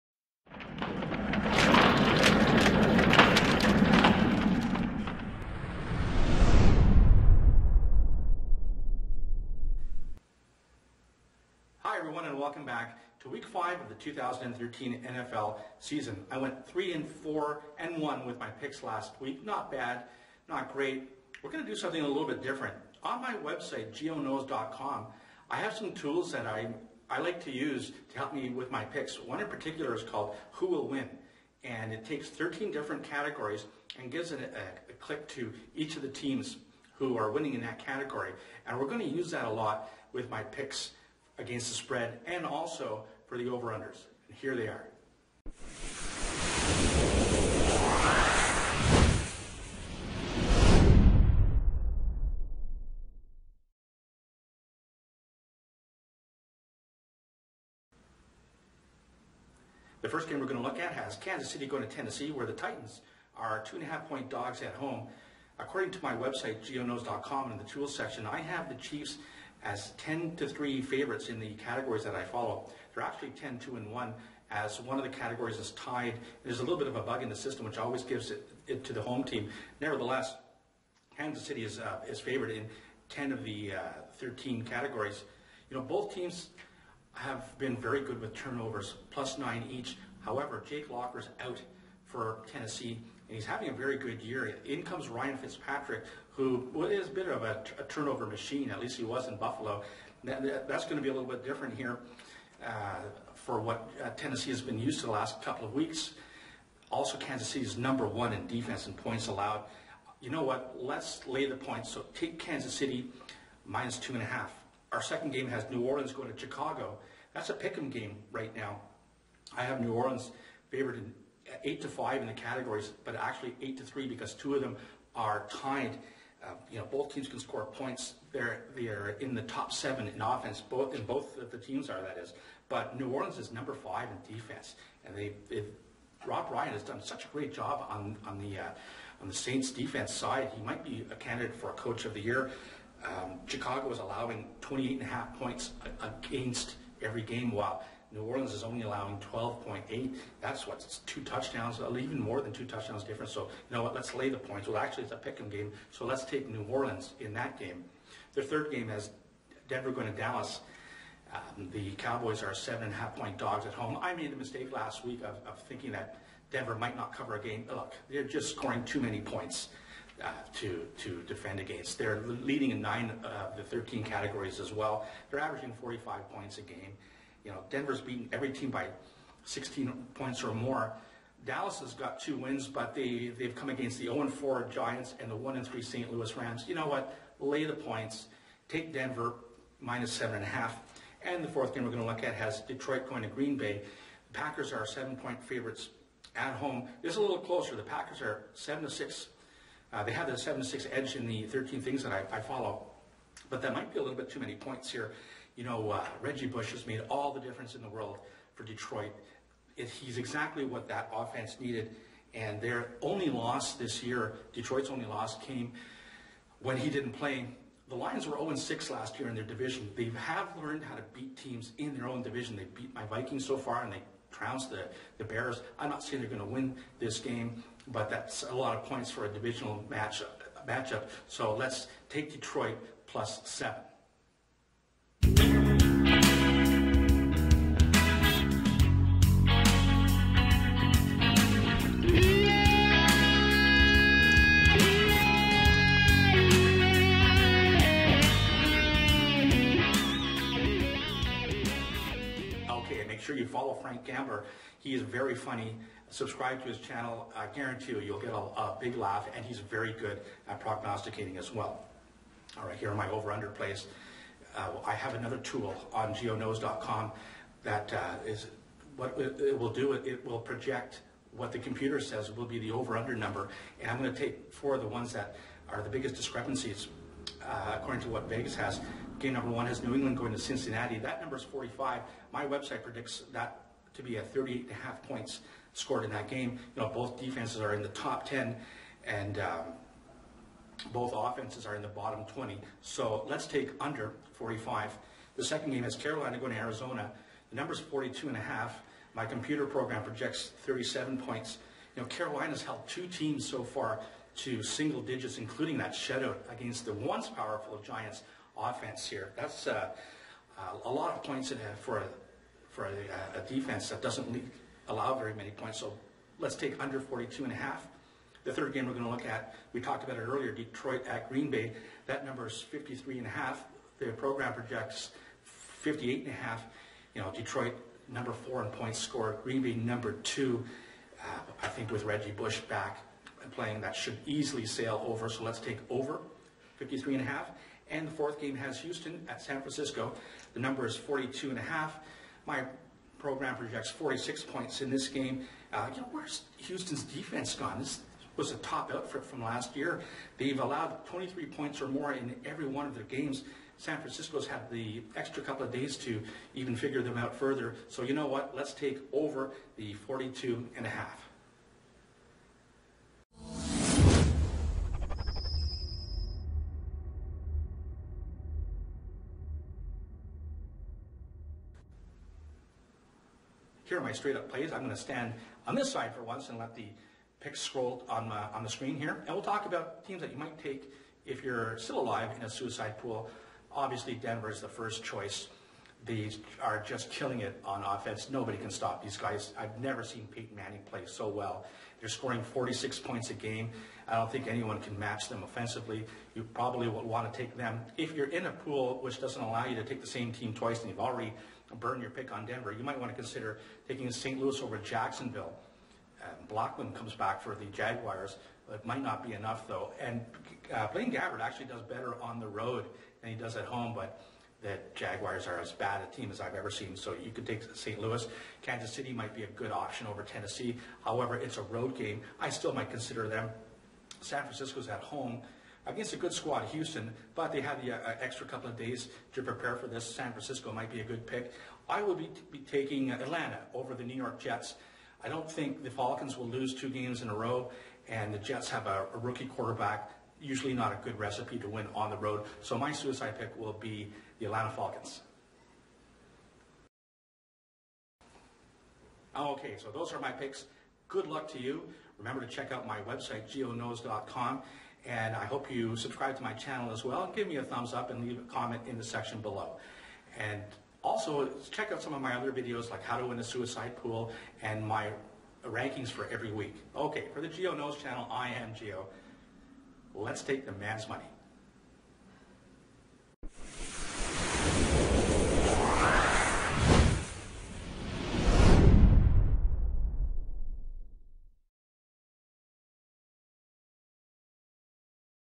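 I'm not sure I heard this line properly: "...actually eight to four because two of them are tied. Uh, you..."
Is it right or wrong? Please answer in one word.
wrong.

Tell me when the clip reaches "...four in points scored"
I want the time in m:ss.
5:28.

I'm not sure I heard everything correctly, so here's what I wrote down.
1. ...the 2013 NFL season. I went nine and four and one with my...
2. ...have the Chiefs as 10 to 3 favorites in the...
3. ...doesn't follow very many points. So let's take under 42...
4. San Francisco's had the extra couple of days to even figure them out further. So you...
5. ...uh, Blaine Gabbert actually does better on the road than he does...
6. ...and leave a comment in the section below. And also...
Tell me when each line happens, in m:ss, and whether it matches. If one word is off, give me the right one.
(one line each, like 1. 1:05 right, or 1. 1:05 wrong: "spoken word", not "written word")
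1. 0:13 wrong: "three", not "nine"
2. 1:08 right
3. 5:14 wrong: "allow", not "follow"
4. 5:53 right
5. 6:50 right
6. 7:38 right.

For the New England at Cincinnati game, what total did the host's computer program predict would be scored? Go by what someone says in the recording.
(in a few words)
38.5.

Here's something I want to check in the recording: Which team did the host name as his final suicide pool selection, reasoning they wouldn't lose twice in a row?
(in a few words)
Atlanta Falcons.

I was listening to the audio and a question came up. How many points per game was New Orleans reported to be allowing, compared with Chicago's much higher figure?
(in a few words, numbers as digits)
12.8.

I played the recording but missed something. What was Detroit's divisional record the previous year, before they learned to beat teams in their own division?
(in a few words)
0-6.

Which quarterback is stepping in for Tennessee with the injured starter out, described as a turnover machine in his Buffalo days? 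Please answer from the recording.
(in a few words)
Ryan Fitzpatrick.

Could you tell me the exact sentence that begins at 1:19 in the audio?
Nevertheless, Kansas City is, uh, is favored in 10 of the uh, 13 categories.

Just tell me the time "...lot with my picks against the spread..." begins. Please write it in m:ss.
0:39.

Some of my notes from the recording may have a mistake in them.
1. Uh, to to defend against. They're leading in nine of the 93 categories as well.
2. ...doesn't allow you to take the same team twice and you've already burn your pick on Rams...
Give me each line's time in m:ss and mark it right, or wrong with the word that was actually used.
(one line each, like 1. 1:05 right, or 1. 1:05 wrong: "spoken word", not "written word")
1. 2:50 wrong: "13", not "93"
2. 6:39 wrong: "Denver", not "Rams".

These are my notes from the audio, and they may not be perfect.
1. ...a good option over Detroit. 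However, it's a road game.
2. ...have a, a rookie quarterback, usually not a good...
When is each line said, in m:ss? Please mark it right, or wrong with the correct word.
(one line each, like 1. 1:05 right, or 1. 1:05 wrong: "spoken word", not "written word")
1. 6:59 wrong: "Tennessee", not "Detroit"
2. 7:18 right.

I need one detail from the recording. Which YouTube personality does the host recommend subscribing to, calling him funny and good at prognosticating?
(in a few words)
Frank Gambler.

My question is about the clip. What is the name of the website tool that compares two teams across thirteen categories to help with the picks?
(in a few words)
Who Will Win.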